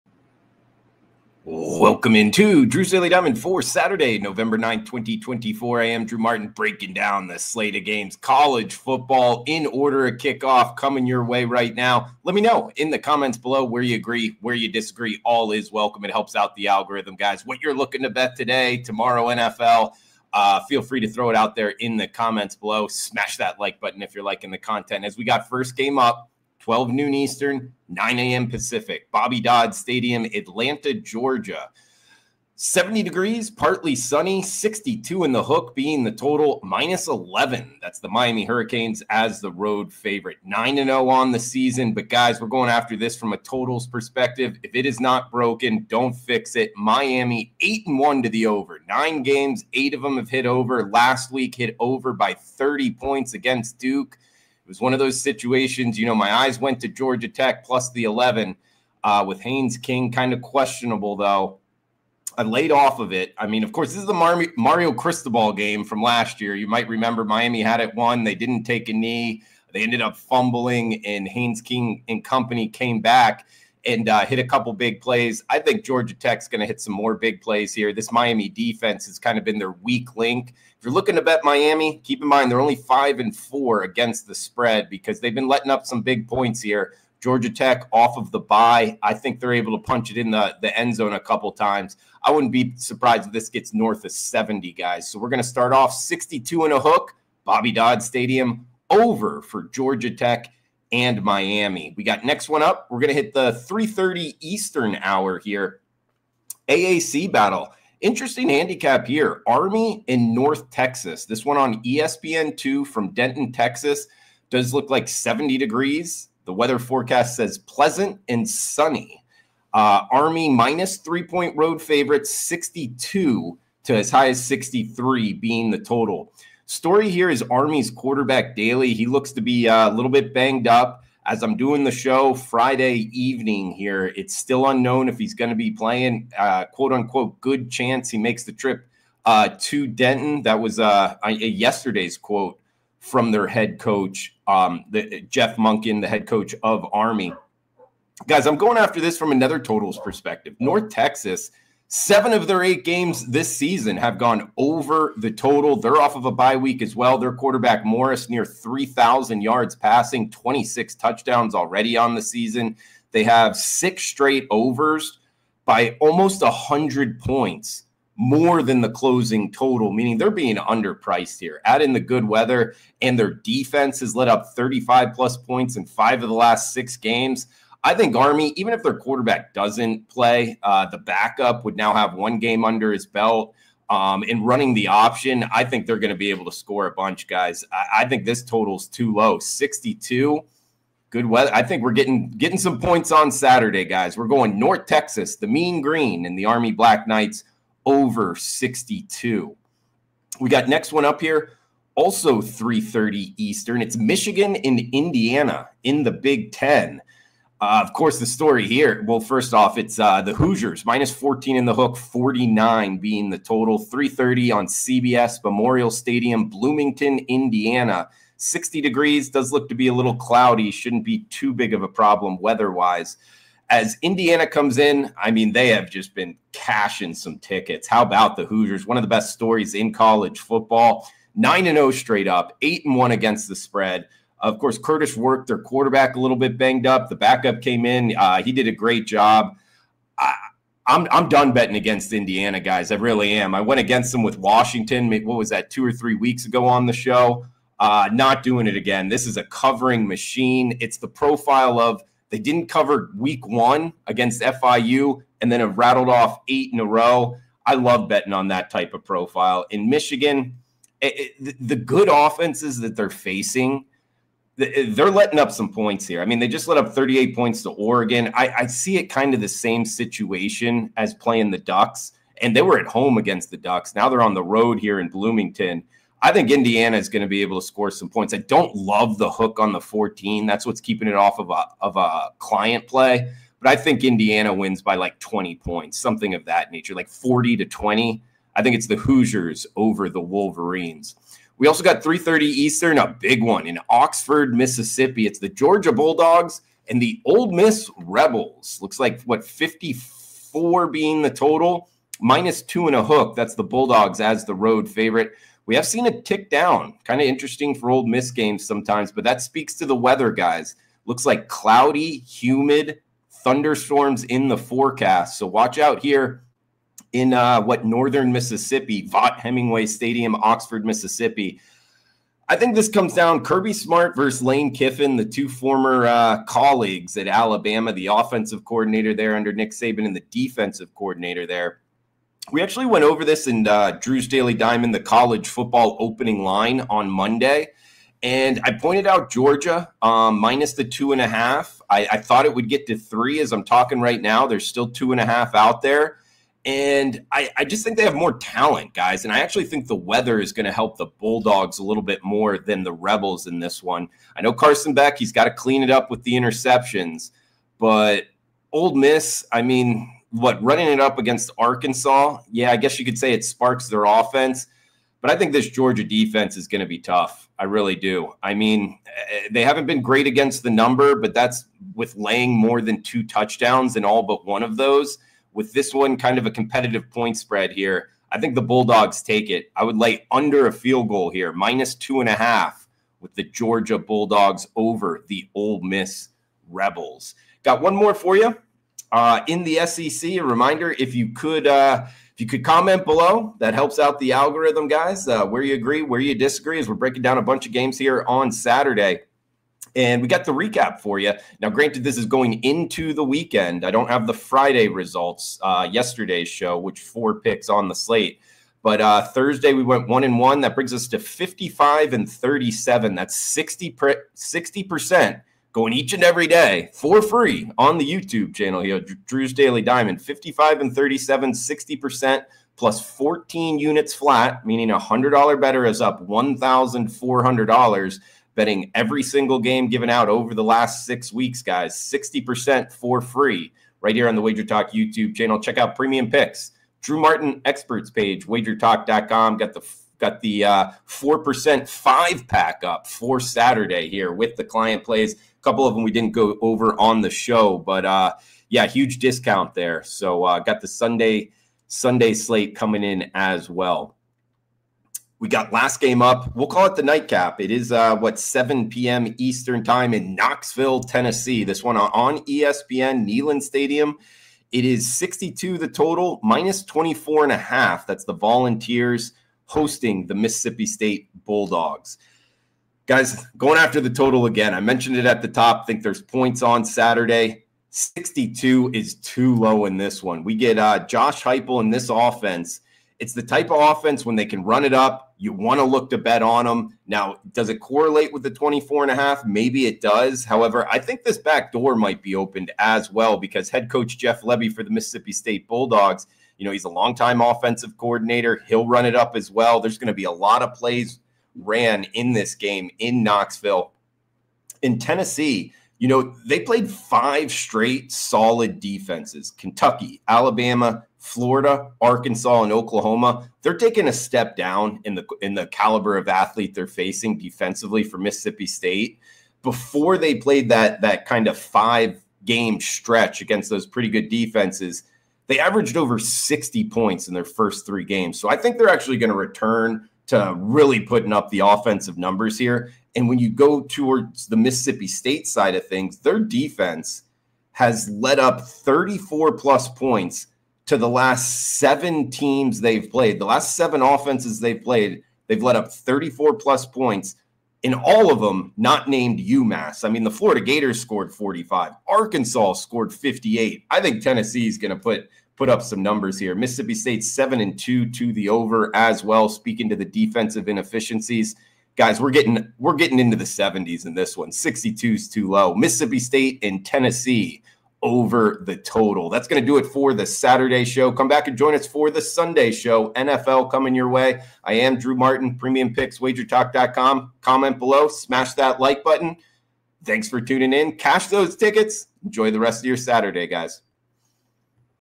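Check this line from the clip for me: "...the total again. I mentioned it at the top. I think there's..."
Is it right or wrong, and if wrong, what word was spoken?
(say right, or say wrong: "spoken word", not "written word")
right.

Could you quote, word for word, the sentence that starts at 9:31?
Come back and join us for the Sunday show.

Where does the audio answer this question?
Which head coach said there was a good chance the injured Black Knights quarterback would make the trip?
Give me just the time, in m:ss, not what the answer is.
2:25.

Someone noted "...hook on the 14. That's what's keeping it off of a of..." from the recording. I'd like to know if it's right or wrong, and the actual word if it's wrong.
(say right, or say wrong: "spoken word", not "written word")
right.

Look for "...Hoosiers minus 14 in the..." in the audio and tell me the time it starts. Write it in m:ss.
3:30.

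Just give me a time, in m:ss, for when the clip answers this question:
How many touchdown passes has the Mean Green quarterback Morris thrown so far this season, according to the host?
2:40.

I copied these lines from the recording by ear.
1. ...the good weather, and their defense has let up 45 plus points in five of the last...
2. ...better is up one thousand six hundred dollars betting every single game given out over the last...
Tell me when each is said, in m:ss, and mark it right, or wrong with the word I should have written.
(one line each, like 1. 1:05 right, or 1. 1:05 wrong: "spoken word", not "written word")
1. 2:51 wrong: "35", not "45"
2. 7:05 wrong: "four", not "six".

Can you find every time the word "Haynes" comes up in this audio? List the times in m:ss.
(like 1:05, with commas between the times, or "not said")
0:59, 1:11.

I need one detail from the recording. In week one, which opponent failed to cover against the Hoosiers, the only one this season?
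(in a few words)
FIU.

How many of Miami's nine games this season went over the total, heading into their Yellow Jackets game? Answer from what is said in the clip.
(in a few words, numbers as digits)
8.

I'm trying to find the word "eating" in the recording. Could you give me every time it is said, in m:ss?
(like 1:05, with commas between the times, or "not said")
not said.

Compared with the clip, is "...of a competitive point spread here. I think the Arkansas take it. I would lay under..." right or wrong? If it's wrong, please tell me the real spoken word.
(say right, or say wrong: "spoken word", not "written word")
wrong: "Bulldogs", not "Arkansas".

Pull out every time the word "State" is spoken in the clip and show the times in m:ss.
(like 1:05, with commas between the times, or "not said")
7:50, 8:15, 8:38, 8:55, 9:16, 9:26.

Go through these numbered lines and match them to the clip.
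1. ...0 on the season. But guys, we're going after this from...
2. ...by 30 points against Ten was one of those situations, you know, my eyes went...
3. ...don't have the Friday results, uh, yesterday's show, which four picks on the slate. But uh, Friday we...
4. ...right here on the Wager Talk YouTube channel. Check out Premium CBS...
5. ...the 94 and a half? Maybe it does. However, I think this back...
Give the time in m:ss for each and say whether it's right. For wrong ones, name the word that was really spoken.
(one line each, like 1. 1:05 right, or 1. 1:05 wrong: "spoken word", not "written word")
1. 0:40 right
2. 0:52 wrong: "Duke", not "Ten"
3. 6:43 wrong: "Thursday", not "Friday"
4. 7:14 wrong: "Picks", not "CBS"
5. 8:08 wrong: "24", not "94".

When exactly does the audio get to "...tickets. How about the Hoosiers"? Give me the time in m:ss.
3:47.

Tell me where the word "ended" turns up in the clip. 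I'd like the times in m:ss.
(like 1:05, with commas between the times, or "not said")
1:09.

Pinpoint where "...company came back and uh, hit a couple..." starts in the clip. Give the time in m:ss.
1:12.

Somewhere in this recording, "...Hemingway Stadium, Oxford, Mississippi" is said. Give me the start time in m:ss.
5:19.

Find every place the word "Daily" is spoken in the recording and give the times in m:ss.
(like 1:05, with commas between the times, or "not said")
0:02, 2:08, 5:34, 6:59.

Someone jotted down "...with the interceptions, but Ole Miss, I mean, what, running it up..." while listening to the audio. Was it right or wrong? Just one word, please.
right.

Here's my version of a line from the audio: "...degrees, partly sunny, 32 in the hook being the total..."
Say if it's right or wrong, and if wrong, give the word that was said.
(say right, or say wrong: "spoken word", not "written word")
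wrong: "62", not "32".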